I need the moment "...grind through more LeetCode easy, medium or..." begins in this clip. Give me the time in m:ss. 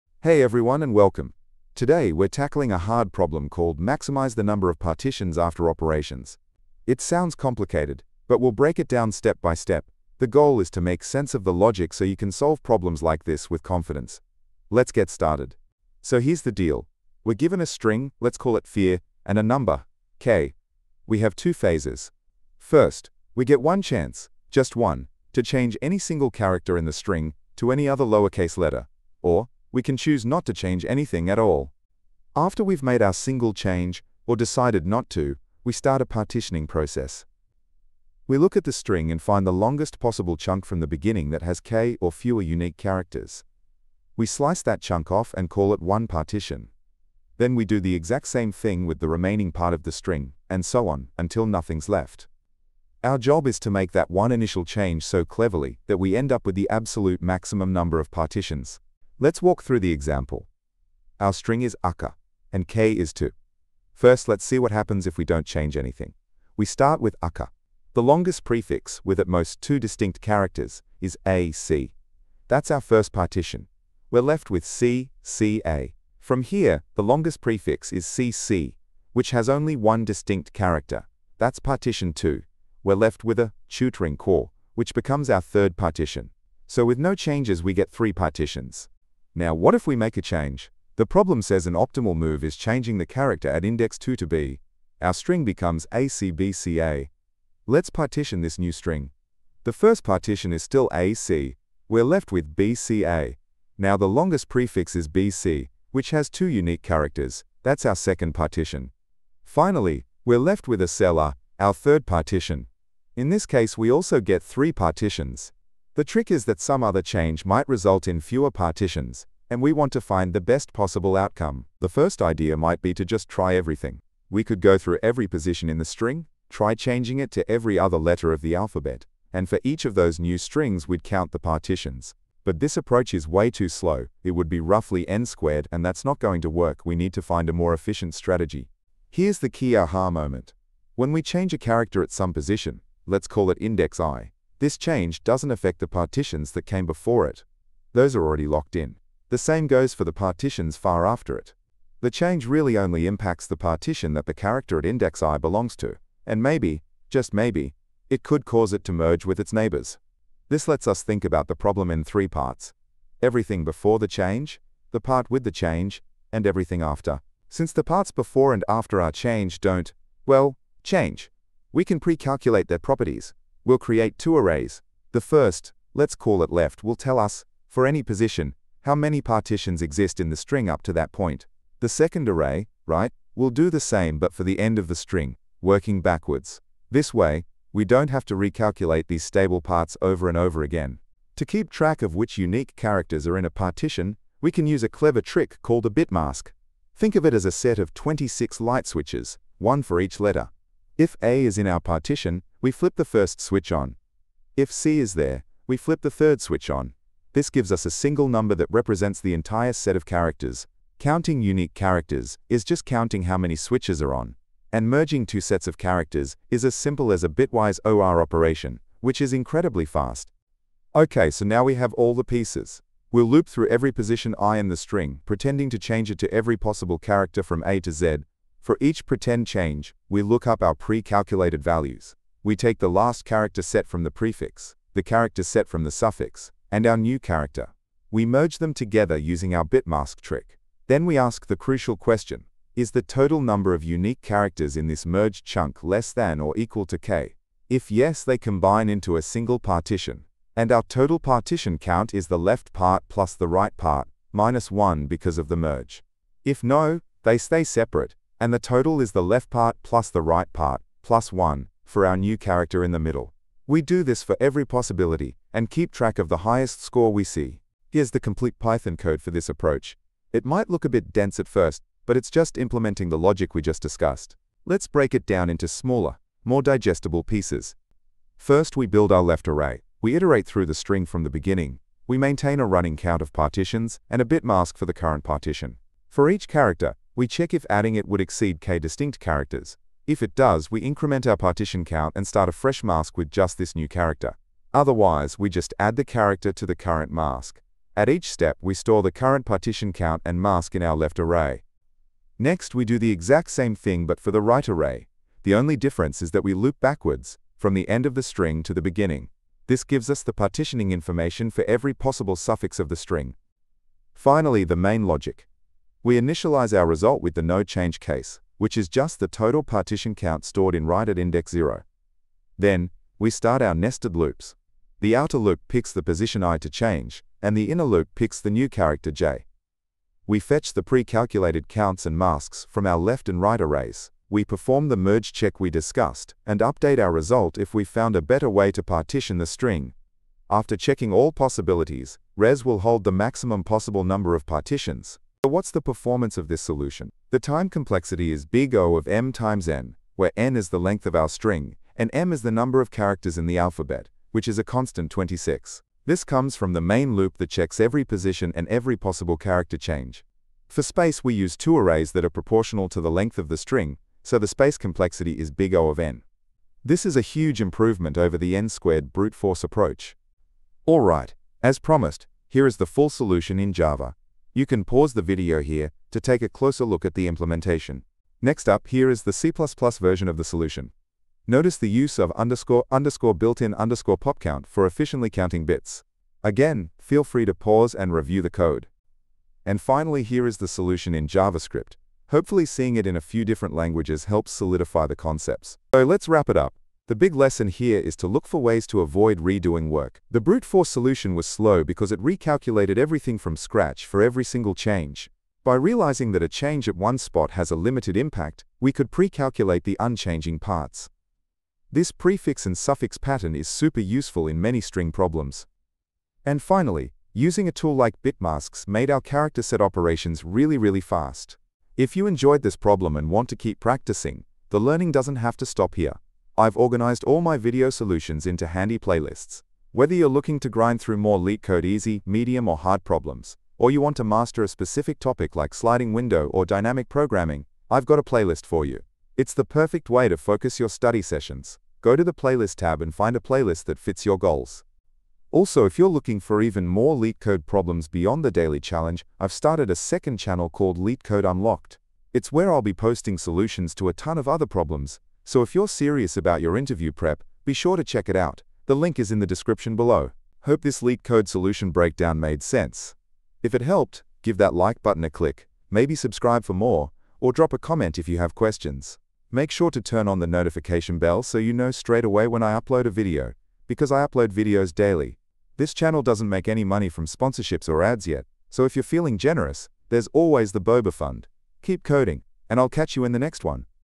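7:10.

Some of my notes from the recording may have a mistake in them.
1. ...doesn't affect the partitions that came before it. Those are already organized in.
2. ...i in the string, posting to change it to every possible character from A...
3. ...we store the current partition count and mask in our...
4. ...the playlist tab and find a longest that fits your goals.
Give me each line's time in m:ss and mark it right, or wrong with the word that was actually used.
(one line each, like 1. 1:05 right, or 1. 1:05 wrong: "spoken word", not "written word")
1. 2:25 wrong: "locked", not "organized"
2. 3:44 wrong: "pretending", not "posting"
3. 4:58 right
4. 7:22 wrong: "playlist", not "longest".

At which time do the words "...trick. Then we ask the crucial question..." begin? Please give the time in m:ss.
4:00.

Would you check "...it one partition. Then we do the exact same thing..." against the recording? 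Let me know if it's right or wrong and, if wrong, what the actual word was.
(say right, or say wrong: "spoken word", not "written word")
right.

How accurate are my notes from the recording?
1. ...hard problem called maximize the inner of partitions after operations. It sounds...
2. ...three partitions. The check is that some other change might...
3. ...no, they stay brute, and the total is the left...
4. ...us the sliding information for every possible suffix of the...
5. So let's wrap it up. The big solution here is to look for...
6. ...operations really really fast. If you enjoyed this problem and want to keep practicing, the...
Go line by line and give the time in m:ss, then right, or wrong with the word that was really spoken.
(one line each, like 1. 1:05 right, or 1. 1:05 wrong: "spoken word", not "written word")
1. 0:02 wrong: "number", not "inner"
2. 1:54 wrong: "trick", not "check"
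3. 4:16 wrong: "separate", not "brute"
4. 5:10 wrong: "partitioning", not "sliding"
5. 6:35 wrong: "lesson", not "solution"
6. 6:59 right.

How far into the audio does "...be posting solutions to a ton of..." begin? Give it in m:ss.
7:32.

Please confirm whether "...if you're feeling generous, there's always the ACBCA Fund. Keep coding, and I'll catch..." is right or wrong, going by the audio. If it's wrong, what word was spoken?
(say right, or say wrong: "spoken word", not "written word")
wrong: "Boba", not "ACBCA".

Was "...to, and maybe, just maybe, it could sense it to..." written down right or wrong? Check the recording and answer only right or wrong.
wrong.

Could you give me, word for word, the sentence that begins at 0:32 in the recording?
After we've made our single change, or decided not to, we start a partitioning process.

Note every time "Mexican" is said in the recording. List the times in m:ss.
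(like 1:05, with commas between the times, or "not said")
not said.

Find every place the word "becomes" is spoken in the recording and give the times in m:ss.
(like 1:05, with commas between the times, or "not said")
1:24, 1:35.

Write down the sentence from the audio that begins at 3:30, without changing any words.
Counting unique characters is just counting how many switches are on.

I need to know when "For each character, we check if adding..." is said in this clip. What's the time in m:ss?
4:46.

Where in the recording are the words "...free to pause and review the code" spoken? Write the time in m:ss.
6:27.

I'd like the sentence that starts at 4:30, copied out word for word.
It might look a bit dense at first, but it's just implementing the logic we just discussed.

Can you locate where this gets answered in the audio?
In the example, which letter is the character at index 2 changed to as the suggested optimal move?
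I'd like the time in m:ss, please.
1:34.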